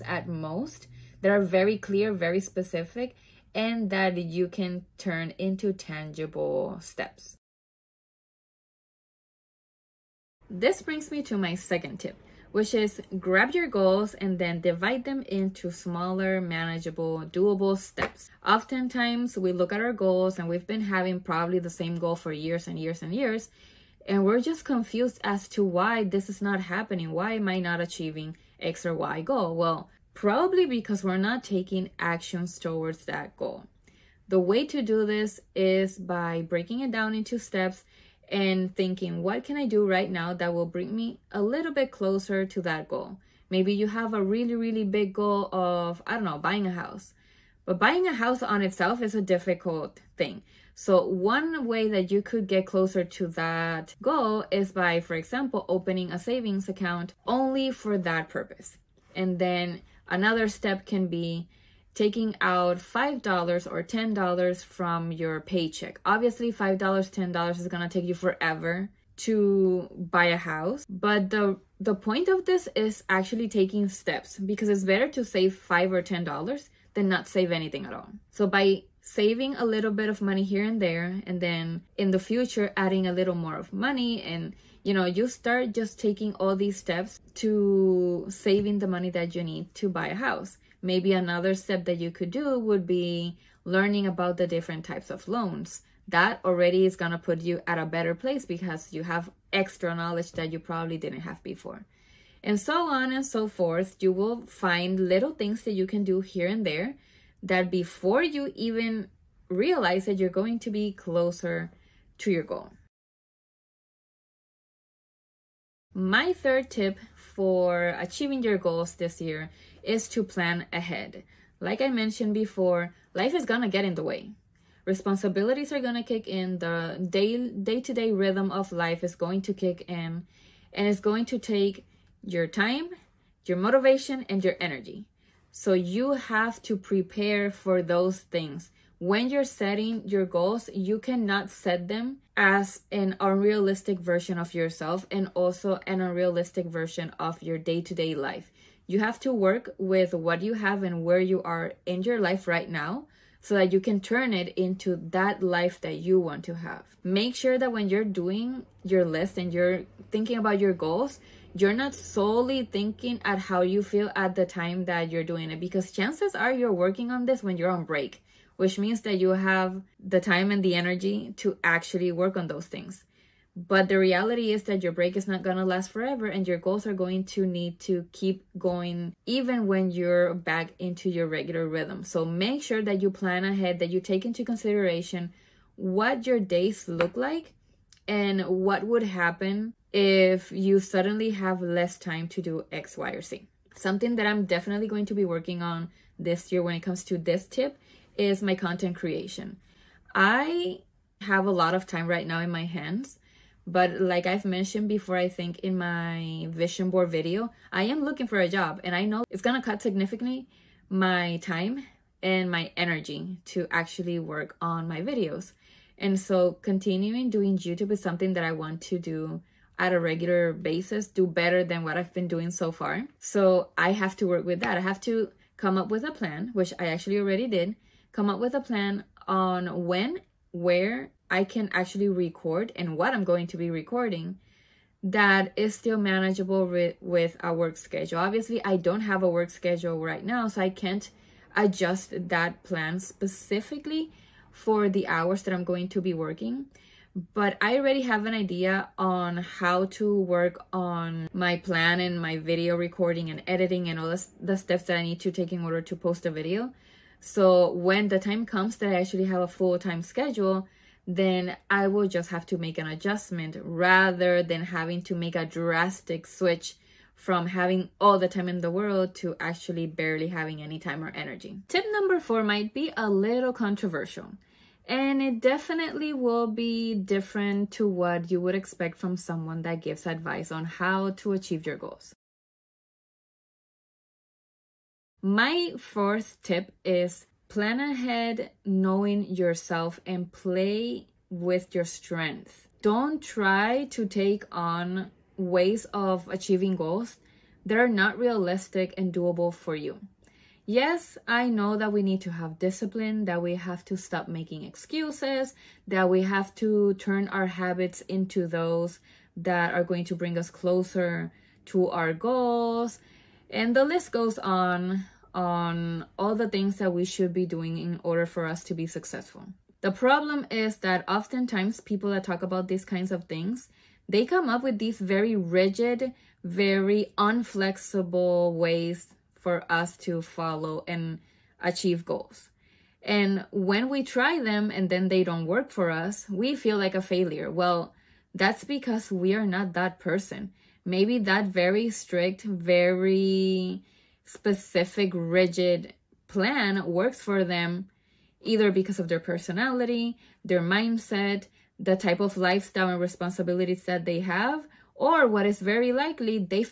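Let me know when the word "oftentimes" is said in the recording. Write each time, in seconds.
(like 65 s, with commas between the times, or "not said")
18 s, 321 s.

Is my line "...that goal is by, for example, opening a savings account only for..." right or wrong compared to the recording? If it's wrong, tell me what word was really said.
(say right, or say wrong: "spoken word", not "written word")
right.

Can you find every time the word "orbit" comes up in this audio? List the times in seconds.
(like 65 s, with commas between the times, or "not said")
not said.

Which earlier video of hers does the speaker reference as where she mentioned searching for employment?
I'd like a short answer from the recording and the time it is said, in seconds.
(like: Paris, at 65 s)
vision board video, at 206 s.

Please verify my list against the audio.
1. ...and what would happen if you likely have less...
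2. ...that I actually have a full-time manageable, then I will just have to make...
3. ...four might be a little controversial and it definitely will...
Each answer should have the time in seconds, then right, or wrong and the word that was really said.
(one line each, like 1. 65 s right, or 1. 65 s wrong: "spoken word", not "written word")
1. 188 s wrong: "suddenly", not "likely"
2. 258 s wrong: "schedule", not "manageable"
3. 272 s right.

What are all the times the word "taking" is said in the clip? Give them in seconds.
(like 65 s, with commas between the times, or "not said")
31 s, 61 s, 73 s, 85 s.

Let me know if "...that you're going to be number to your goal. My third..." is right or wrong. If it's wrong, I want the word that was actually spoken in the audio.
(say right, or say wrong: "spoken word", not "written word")
wrong: "closer", not "number".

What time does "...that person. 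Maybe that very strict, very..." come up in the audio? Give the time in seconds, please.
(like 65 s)
339 s.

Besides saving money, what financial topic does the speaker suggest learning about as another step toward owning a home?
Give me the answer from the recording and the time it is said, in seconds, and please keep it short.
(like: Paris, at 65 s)
different types of loans, at 94 s.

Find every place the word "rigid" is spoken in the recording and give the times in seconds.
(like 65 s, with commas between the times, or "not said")
325 s, 345 s.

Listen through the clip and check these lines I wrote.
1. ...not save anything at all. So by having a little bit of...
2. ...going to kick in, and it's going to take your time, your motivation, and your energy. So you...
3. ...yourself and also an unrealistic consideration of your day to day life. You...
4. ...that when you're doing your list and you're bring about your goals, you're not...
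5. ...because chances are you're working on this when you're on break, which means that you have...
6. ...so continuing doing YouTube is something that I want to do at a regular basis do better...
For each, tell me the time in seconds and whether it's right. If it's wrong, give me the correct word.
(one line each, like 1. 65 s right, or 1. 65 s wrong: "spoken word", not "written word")
1. 77 s wrong: "saving", not "having"
2. 129 s right
3. 144 s wrong: "version", not "consideration"
4. 157 s wrong: "thinking", not "bring"
5. 165 s right
6. 216 s right.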